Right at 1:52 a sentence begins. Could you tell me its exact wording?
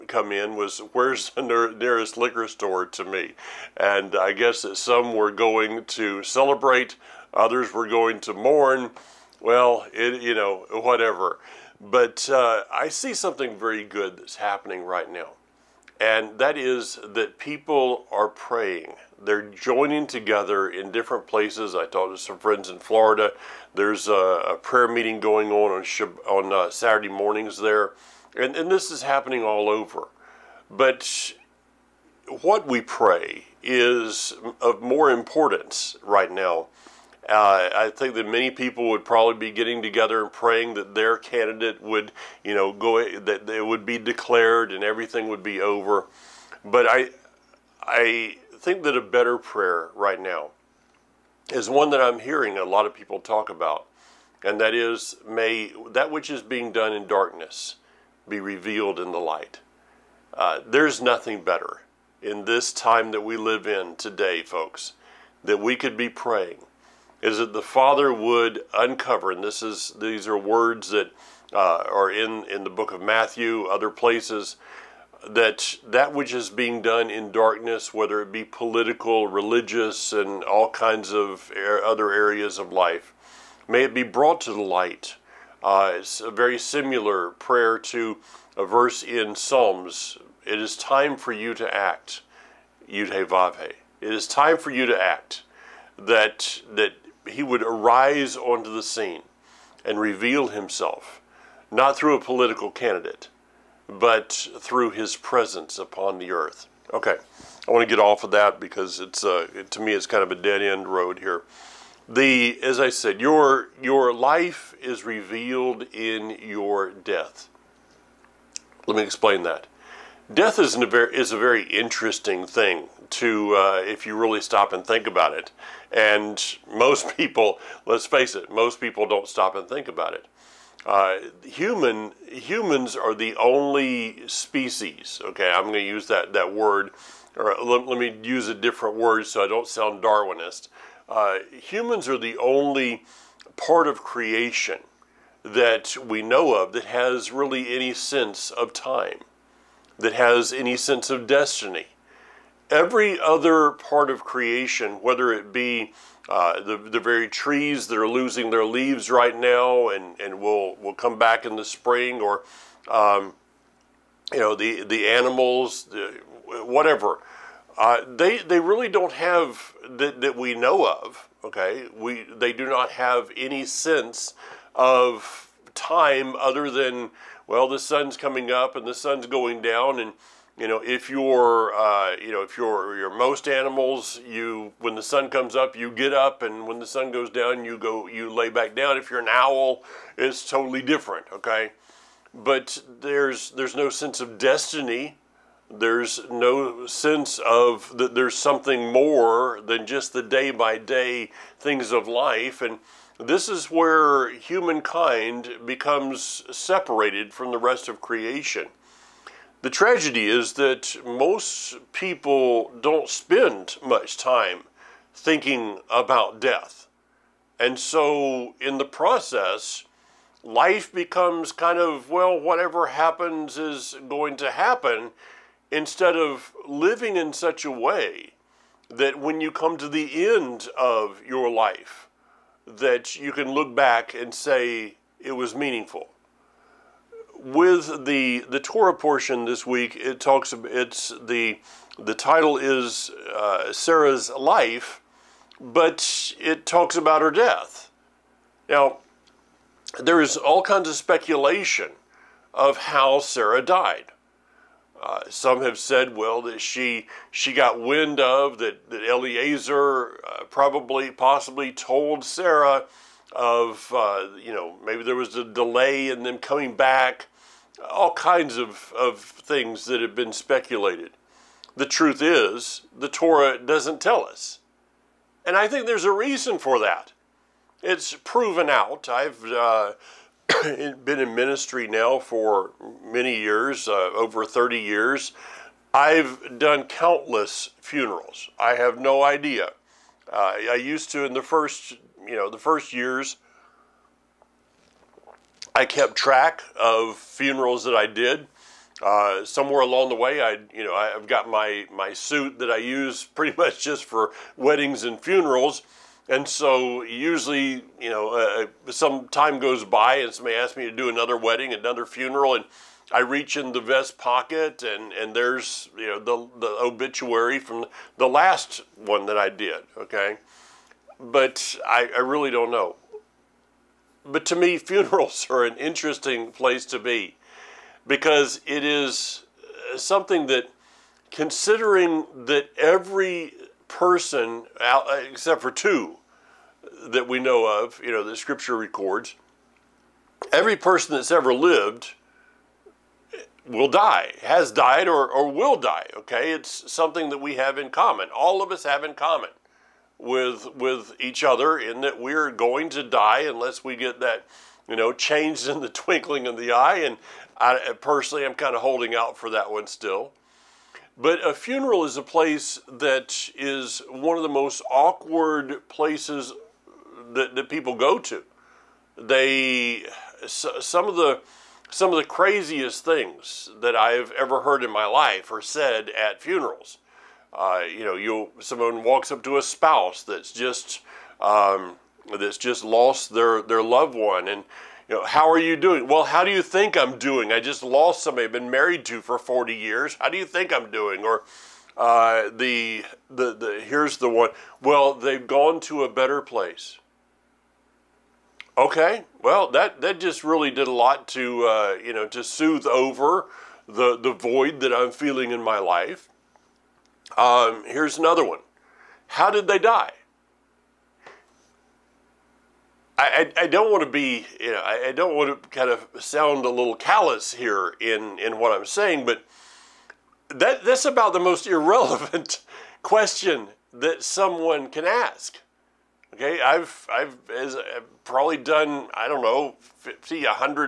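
The as I said, your your life is revealed in your death.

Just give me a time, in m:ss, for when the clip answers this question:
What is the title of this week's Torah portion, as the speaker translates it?
4:03.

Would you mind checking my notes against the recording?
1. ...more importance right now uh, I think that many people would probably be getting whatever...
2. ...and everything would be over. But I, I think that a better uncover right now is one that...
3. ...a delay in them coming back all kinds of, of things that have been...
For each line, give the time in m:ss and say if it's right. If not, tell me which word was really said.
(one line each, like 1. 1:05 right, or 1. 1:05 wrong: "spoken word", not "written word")
1. 0:34 wrong: "together", not "whatever"
2. 0:44 wrong: "prayer", not "uncover"
3. 4:25 right.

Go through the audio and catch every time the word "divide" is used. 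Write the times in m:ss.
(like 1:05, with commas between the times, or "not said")
not said.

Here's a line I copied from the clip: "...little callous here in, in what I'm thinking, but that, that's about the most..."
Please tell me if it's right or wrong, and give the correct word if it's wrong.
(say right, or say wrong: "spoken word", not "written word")
wrong: "saying", not "thinking".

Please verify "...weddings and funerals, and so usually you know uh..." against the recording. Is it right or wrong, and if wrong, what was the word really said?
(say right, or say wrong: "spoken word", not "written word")
right.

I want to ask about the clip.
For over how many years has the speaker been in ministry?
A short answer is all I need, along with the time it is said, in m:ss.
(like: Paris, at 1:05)
30 years, at 4:44.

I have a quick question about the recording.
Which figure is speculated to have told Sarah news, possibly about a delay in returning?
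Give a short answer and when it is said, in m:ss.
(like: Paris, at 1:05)
Eliezer, at 4:19.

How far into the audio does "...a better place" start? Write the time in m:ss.
6:36.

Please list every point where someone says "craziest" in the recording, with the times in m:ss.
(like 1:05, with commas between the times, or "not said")
6:12.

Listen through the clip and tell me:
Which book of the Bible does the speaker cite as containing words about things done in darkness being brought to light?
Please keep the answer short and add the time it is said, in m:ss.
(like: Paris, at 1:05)
Matthew, at 1:13.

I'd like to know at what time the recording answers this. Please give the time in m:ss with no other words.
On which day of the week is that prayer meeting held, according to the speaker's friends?
0:26.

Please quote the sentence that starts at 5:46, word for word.
It's something that we have in common.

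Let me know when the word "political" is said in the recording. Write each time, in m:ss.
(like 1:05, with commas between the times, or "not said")
1:18, 1:42.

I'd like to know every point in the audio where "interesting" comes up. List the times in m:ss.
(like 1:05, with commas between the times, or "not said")
2:01, 5:25.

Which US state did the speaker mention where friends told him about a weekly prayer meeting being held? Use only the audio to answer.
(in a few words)
Florida.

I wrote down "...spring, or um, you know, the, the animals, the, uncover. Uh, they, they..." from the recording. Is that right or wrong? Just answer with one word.
wrong.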